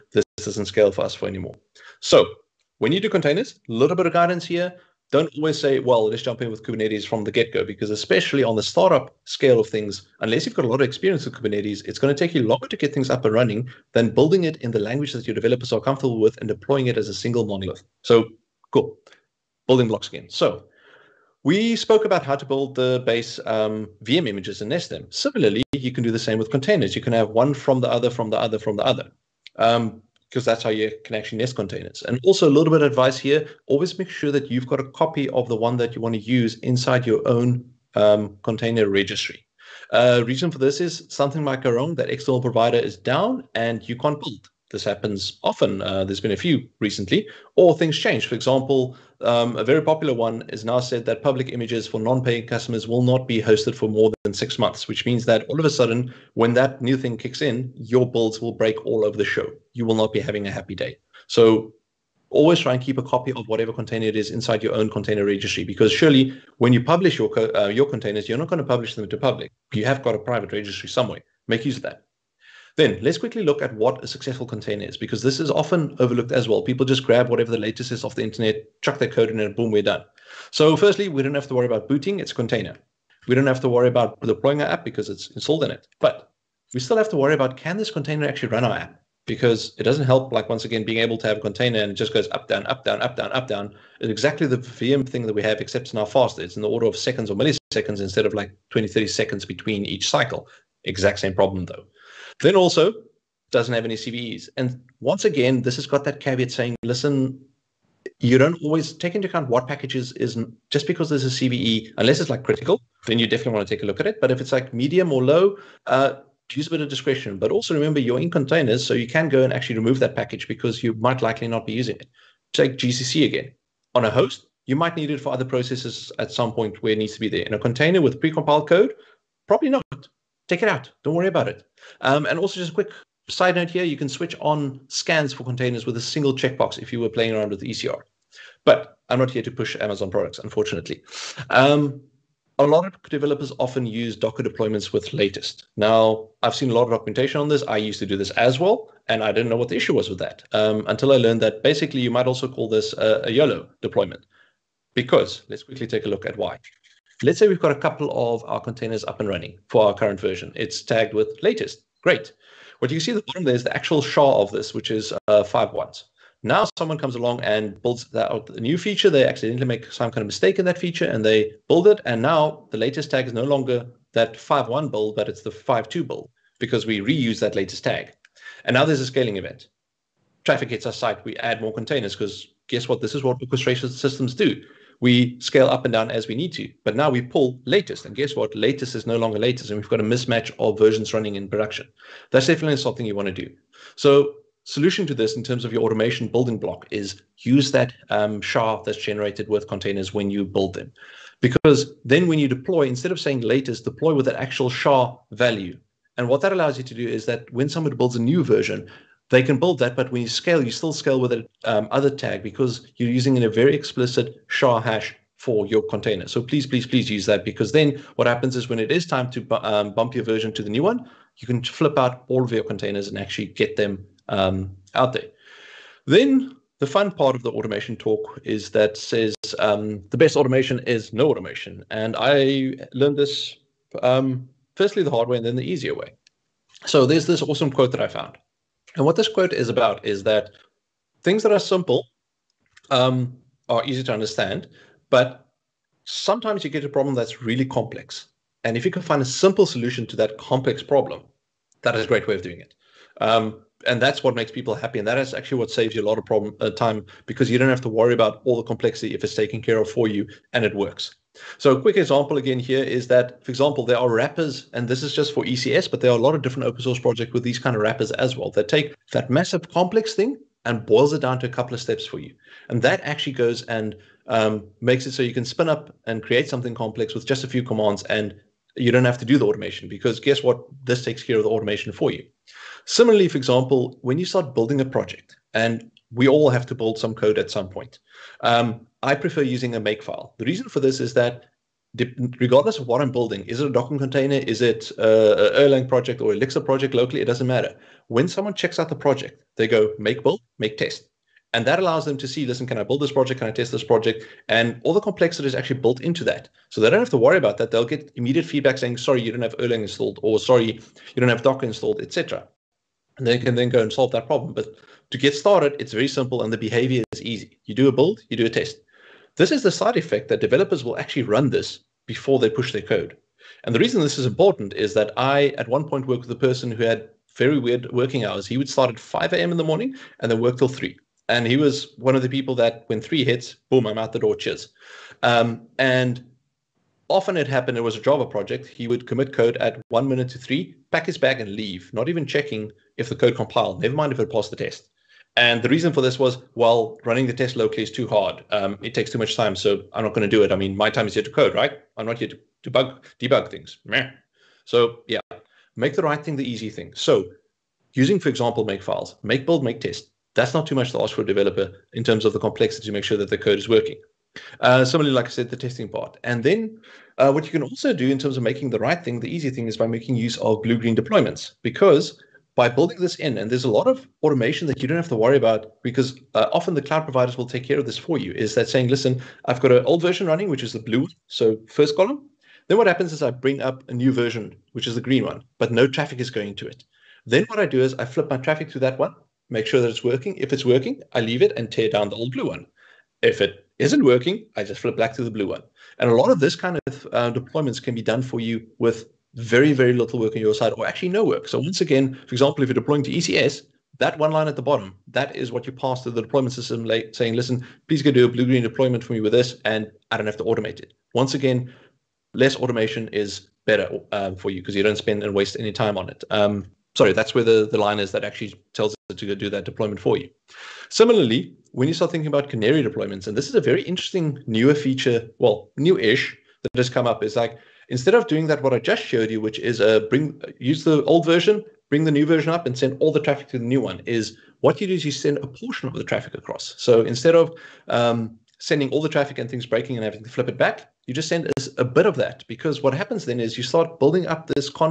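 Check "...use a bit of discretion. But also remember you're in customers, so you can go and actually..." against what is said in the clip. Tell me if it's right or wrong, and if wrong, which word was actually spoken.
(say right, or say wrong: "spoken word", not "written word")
wrong: "containers", not "customers".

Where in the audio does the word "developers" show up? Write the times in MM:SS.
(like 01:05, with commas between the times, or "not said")
00:15, 02:23, 05:20, 06:01.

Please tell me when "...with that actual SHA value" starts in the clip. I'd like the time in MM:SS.
03:24.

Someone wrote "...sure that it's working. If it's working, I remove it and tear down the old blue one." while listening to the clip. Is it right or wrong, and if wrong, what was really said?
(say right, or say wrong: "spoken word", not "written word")
wrong: "leave", not "remove".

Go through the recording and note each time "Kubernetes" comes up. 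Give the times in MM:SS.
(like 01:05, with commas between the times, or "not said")
00:06, 00:11.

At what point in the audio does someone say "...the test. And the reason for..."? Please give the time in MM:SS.
05:44.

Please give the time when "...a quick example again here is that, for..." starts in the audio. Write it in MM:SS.
04:21.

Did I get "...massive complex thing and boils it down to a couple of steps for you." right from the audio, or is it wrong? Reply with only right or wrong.
right.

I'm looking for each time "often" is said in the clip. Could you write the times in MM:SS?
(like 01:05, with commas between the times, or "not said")
00:45, 01:15, 02:23, 05:37, 06:16.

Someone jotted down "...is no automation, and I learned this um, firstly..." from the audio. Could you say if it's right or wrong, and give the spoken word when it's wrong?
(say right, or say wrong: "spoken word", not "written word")
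right.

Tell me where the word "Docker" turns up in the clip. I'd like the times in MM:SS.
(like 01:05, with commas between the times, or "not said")
02:24, 04:53, 05:11.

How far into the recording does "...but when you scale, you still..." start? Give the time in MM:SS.
03:29.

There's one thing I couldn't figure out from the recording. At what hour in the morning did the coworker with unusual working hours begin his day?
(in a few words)
5 a.m.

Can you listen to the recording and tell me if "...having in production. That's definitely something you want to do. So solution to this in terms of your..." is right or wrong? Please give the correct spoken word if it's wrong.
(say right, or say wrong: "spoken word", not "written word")
wrong: "running", not "having".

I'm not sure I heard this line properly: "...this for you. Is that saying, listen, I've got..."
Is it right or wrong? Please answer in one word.
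right.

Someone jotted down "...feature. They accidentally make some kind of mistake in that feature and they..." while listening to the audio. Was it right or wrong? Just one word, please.
right.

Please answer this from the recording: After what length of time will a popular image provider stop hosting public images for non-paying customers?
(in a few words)
6 months.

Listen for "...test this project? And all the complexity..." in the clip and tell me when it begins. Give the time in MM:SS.
05:03.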